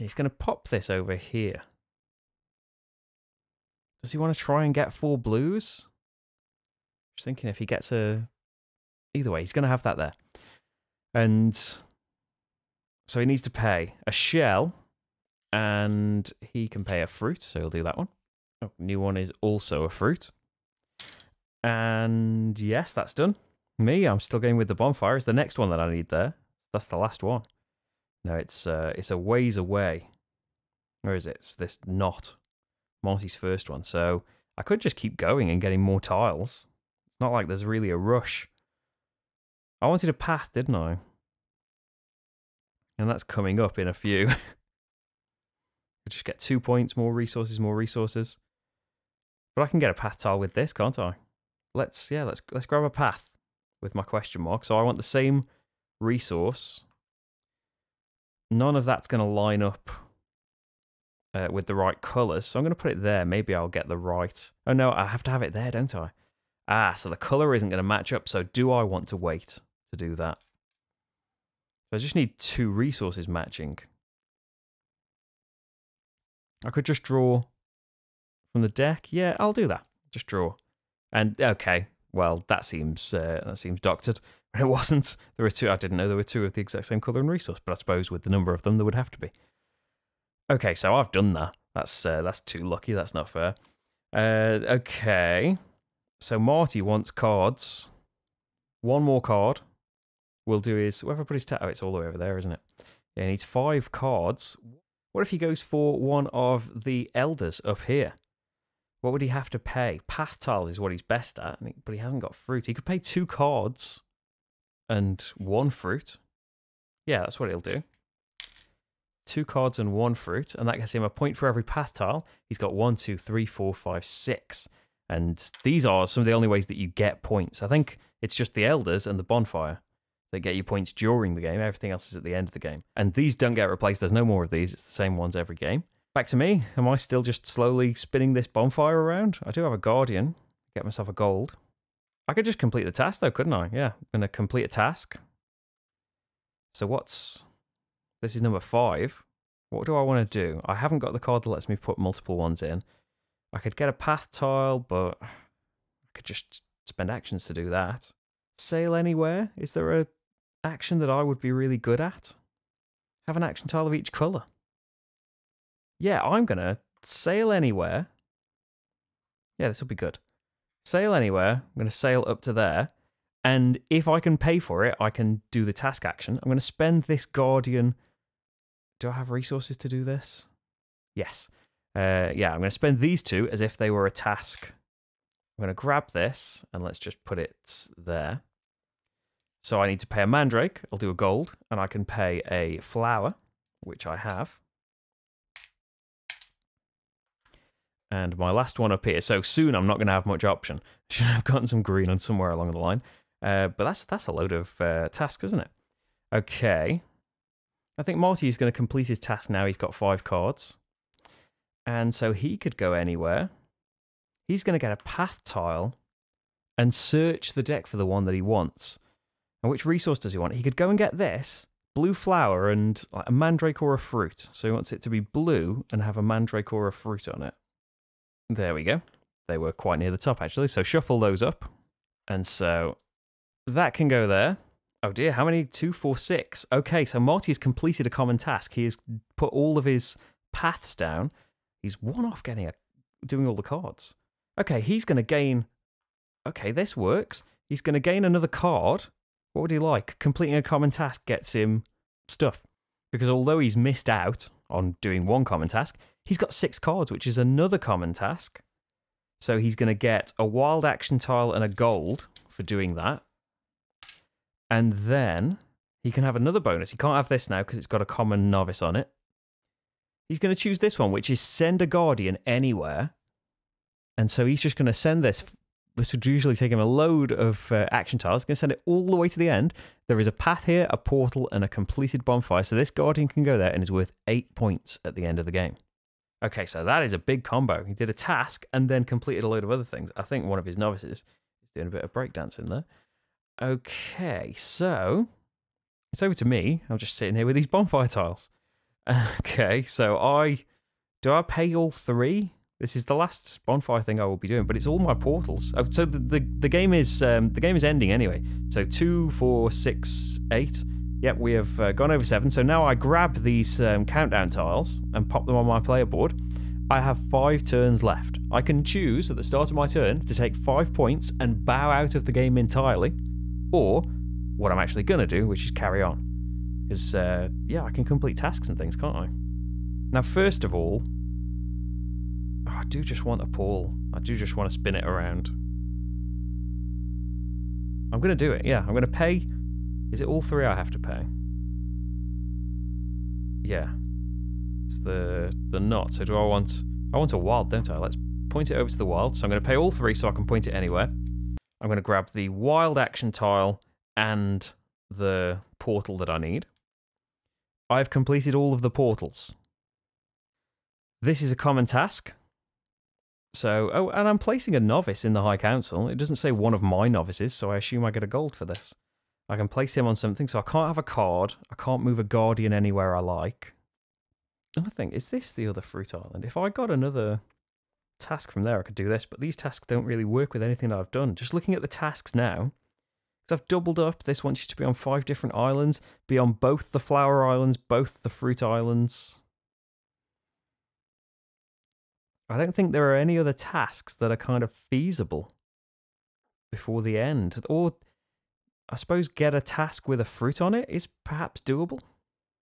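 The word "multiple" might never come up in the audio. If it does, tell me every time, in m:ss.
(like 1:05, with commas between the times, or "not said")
2:31.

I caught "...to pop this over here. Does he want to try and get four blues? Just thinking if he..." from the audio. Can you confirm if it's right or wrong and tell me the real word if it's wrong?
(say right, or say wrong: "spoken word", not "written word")
right.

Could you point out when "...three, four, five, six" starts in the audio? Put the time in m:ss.
2:03.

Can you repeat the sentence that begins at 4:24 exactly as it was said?
And then he can have another bonus.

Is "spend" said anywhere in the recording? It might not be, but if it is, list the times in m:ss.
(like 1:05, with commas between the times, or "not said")
2:36, 2:56, 3:02.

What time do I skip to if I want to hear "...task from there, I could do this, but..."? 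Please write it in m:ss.
6:18.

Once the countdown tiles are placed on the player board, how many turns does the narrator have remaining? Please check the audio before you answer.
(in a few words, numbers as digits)
5.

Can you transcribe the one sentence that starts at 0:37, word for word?
It's not like there's really a rush.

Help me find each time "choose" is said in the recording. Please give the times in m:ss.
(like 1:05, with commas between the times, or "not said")
4:30, 5:18.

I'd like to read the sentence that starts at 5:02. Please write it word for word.
This is the last bonfire thing I will be doing, but it's all my portals.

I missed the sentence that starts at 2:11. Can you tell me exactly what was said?
Everything else is at the end of the game.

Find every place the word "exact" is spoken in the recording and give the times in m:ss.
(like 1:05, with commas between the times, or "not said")
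1:26.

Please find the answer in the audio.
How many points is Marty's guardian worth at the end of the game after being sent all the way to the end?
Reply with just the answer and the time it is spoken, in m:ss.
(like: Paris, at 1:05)
8, at 4:44.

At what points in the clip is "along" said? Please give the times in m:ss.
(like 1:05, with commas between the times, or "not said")
3:22.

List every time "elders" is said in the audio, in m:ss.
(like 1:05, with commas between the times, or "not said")
1:47, 2:08.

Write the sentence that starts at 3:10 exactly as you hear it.
I'll do a gold and I can pay a flower, which I have.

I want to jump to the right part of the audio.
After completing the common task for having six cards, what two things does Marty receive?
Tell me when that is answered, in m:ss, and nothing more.
4:20.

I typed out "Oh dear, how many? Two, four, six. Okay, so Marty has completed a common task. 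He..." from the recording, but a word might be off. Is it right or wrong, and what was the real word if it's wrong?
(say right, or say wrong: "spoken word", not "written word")
right.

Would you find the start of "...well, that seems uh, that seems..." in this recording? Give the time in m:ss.
1:22.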